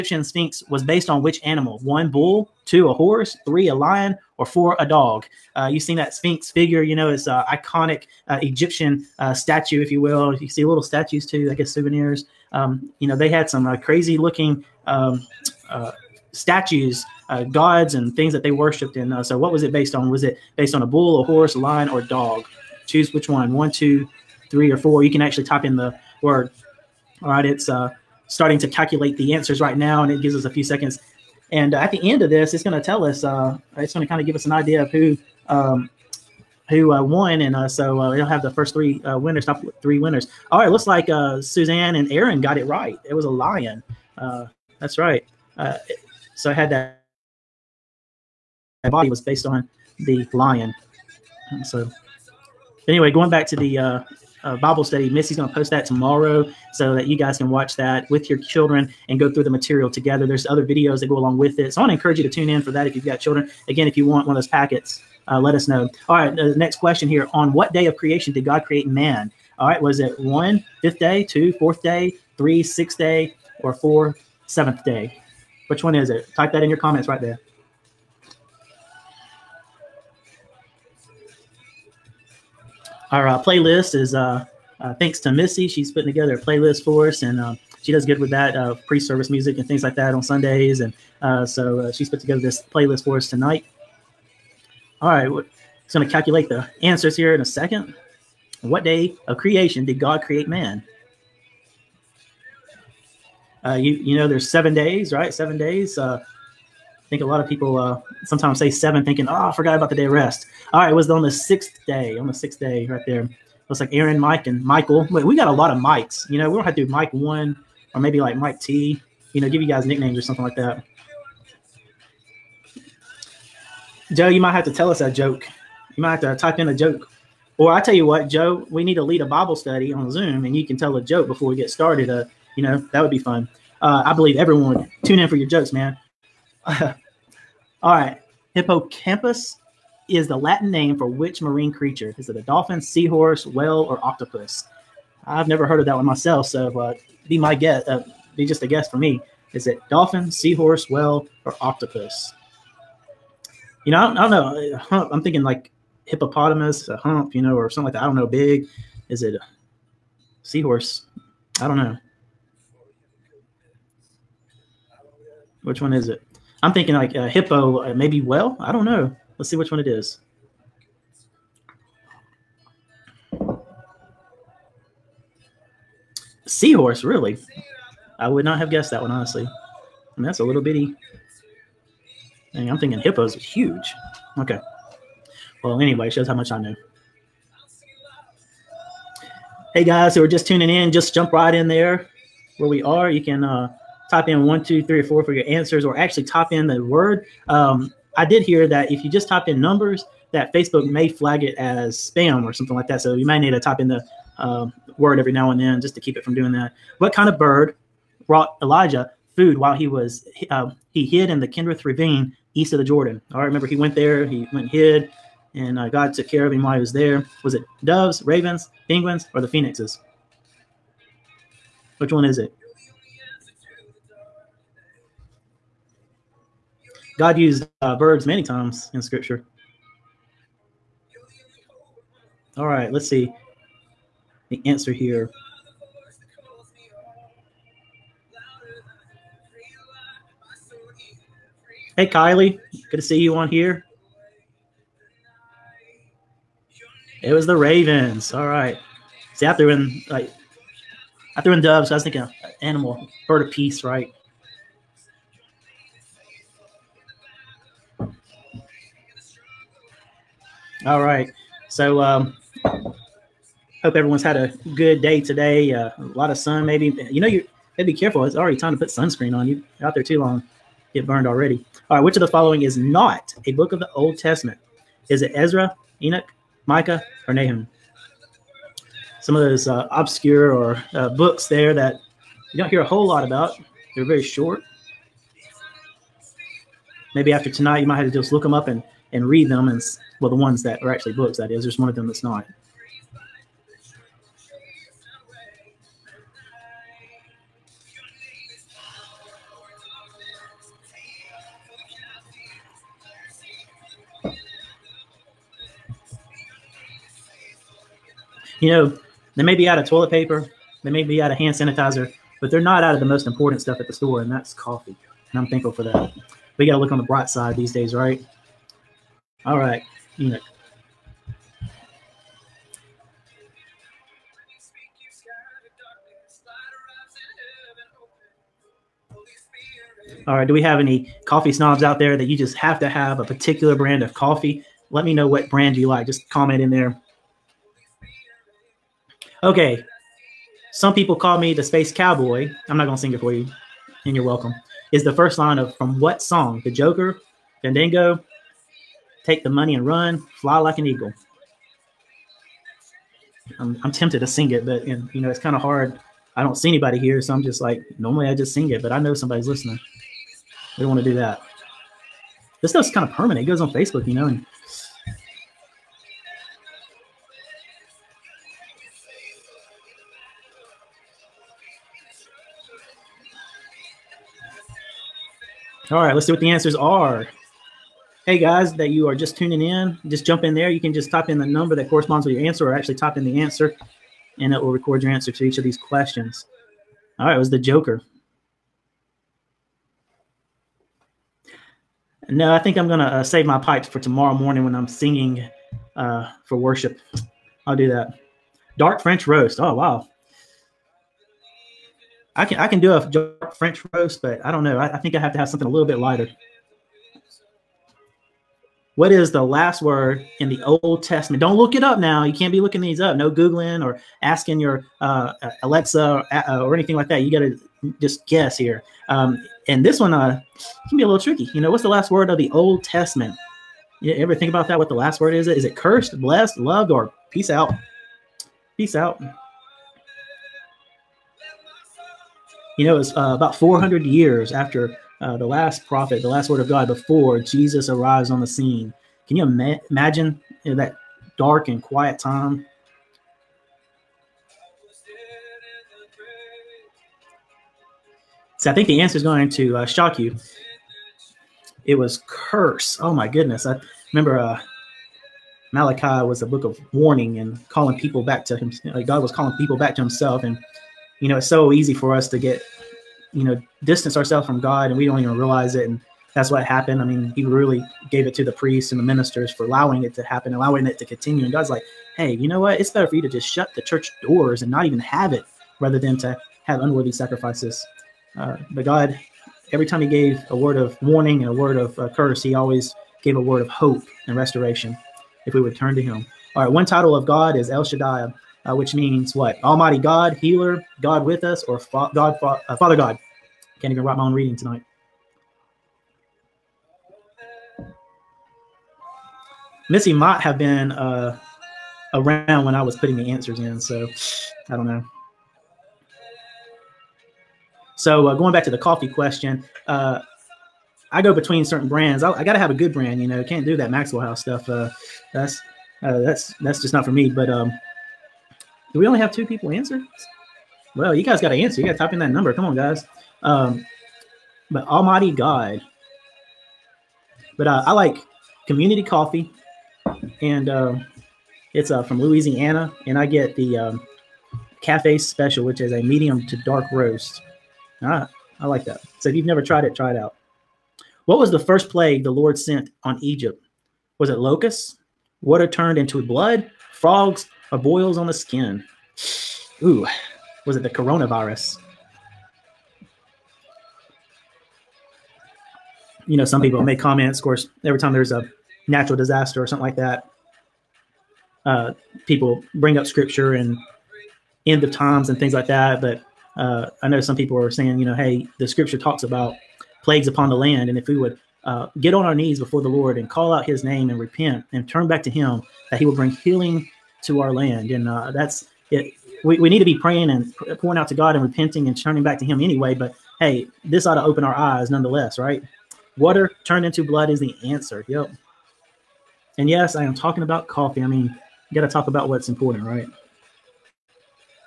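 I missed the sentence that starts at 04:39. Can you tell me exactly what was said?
Some of those uh, obscure or uh, books there that you don't hear a whole lot about.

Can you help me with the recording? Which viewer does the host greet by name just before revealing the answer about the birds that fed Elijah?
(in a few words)
Kylie.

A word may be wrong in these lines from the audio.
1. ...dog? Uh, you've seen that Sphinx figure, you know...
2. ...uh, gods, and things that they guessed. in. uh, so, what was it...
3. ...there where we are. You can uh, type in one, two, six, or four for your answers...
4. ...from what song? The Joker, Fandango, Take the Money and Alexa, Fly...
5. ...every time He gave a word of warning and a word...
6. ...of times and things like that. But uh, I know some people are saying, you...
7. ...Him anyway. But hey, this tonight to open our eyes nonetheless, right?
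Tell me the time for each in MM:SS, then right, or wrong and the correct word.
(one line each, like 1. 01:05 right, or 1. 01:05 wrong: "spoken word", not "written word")
1. 00:04 right
2. 00:17 wrong: "worshipped", not "guessed"
3. 03:11 wrong: "three", not "six"
4. 05:45 wrong: "Run", not "Alexa"
5. 07:59 right
6. 09:24 right
7. 09:42 wrong: "ought", not "tonight".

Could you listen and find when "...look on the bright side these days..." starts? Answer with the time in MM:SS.
05:16.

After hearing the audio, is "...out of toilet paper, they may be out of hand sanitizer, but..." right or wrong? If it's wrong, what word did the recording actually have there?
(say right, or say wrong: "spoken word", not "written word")
right.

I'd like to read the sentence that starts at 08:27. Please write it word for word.
So uh, going back to the coffee question, uh, I go between certain brands.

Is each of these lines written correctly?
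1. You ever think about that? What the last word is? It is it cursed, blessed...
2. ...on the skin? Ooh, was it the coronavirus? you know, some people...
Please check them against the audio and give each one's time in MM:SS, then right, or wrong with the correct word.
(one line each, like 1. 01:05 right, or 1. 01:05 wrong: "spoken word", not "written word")
1. 07:04 right
2. 09:08 right.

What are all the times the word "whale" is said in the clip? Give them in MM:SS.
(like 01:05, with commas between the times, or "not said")
02:23, 02:30.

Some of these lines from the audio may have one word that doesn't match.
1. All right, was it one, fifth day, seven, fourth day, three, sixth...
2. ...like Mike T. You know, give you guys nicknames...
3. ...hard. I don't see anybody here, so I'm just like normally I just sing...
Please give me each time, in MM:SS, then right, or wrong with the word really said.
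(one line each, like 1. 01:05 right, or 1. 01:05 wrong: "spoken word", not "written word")
1. 01:09 wrong: "two", not "seven"
2. 01:58 right
3. 05:55 right.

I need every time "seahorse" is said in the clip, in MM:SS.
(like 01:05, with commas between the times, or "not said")
02:22, 02:30, 02:40, 02:56.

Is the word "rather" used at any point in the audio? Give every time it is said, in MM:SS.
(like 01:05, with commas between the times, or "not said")
07:55.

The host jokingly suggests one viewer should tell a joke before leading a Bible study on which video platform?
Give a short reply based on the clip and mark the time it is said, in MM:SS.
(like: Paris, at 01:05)
Zoom, at 02:10.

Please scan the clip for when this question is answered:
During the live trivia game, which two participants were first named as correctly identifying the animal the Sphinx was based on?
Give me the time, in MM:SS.
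00:41.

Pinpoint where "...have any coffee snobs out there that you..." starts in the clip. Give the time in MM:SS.
05:30.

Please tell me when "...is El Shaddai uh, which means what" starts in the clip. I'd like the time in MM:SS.
08:07.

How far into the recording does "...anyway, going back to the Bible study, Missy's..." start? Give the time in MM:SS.
00:52.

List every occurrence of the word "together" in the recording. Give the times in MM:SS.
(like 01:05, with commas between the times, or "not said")
00:59, 01:26, 01:32.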